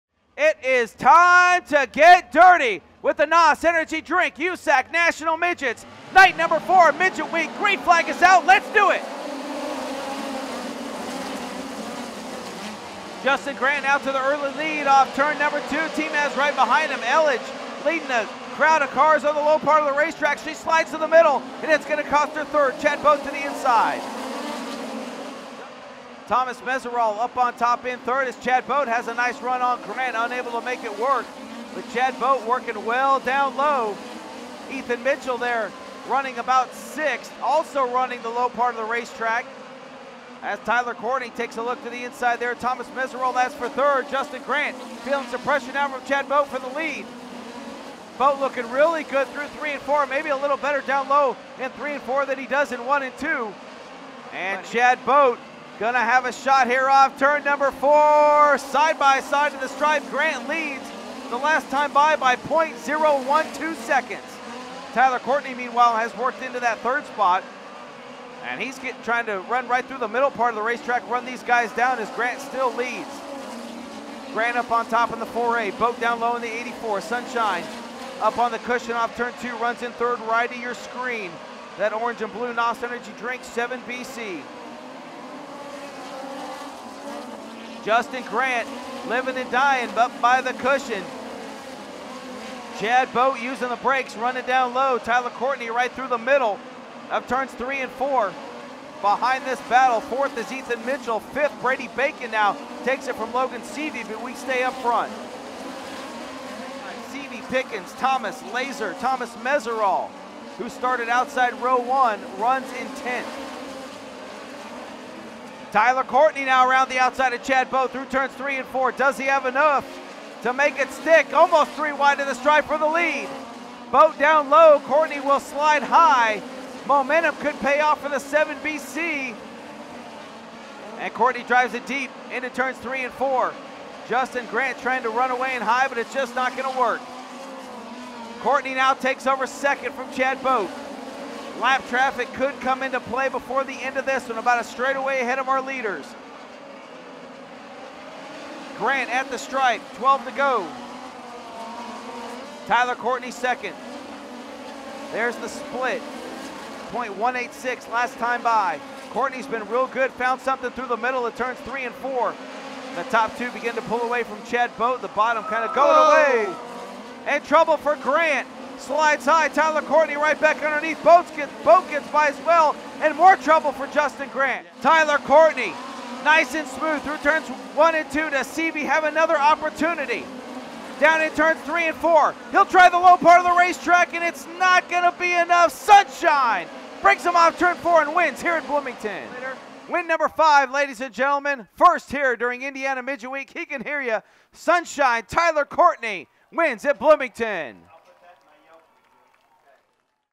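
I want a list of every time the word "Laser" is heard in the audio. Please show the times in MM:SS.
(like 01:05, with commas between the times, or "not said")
01:48.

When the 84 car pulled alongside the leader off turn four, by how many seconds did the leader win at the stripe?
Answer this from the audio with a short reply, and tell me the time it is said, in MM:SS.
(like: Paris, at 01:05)
0.012 seconds, at 01:02.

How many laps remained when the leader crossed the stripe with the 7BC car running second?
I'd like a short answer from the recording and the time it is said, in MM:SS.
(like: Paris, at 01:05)
12, at 02:29.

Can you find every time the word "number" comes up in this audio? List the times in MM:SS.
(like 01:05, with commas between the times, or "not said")
00:06, 00:15, 00:57, 03:10.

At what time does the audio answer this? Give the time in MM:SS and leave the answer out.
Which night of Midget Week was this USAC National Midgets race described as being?
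00:06.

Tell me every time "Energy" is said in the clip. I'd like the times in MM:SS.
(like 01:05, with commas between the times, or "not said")
00:03, 01:22.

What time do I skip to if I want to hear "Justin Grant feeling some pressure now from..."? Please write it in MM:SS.
00:44.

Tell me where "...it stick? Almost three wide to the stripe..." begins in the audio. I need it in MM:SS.
02:00.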